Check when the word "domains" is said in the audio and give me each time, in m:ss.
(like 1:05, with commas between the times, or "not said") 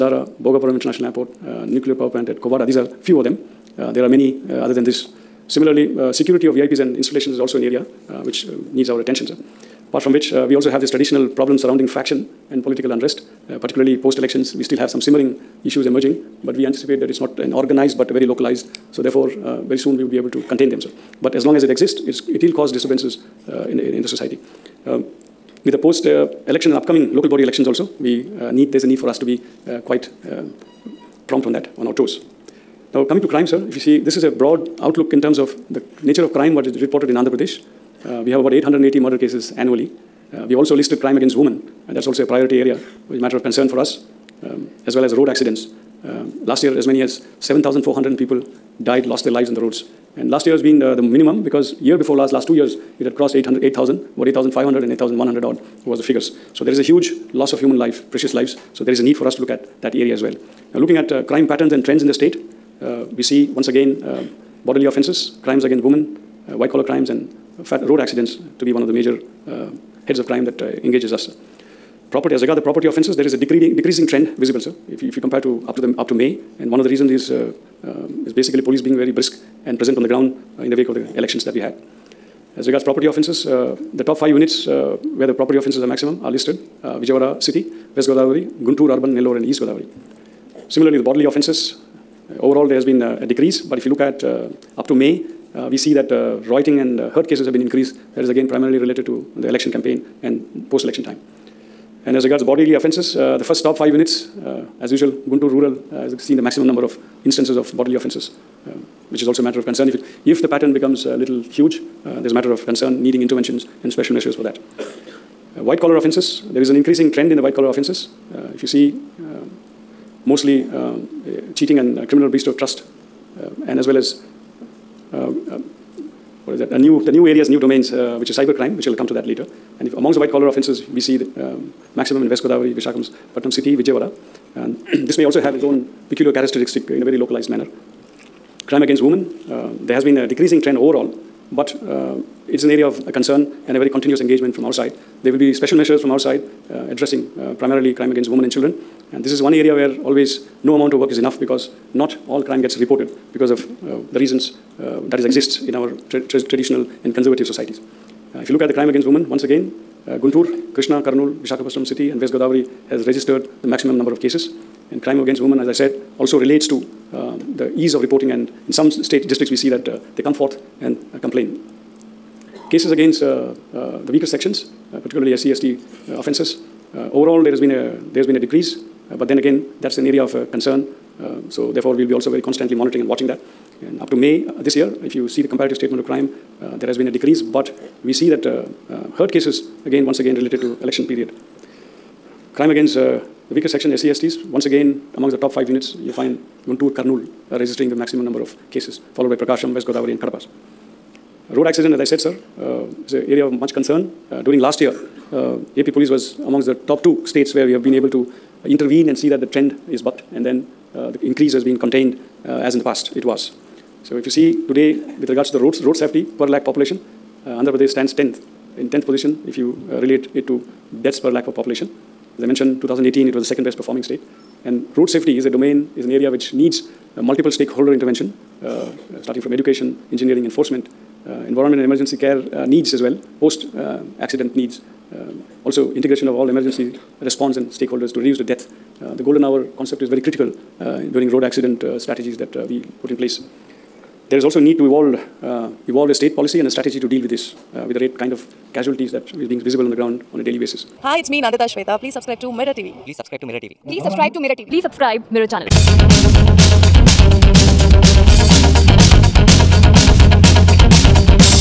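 2:07, 3:45.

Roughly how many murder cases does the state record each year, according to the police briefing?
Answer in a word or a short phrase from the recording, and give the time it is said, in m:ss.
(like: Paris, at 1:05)
880, at 0:38.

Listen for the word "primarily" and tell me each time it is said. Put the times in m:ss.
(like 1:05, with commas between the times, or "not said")
1:38, 2:27.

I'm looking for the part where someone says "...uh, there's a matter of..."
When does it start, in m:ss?
1:52.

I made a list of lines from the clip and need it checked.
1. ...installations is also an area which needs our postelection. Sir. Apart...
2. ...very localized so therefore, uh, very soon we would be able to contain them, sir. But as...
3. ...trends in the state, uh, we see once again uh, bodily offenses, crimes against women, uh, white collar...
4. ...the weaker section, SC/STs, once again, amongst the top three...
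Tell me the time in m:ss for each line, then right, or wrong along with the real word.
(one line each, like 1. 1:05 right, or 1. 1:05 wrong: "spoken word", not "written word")
1. 0:06 wrong: "attention", not "postelection"
2. 0:18 right
3. 1:01 right
4. 3:13 wrong: "five", not "three".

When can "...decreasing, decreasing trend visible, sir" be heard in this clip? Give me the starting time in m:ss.
1:13.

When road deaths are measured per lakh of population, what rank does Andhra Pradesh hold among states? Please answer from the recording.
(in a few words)
10th.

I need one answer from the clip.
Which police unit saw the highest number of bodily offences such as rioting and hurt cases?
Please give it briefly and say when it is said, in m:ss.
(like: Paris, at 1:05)
Guntur Rural, at 1:45.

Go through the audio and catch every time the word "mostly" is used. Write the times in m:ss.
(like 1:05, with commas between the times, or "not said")
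2:00.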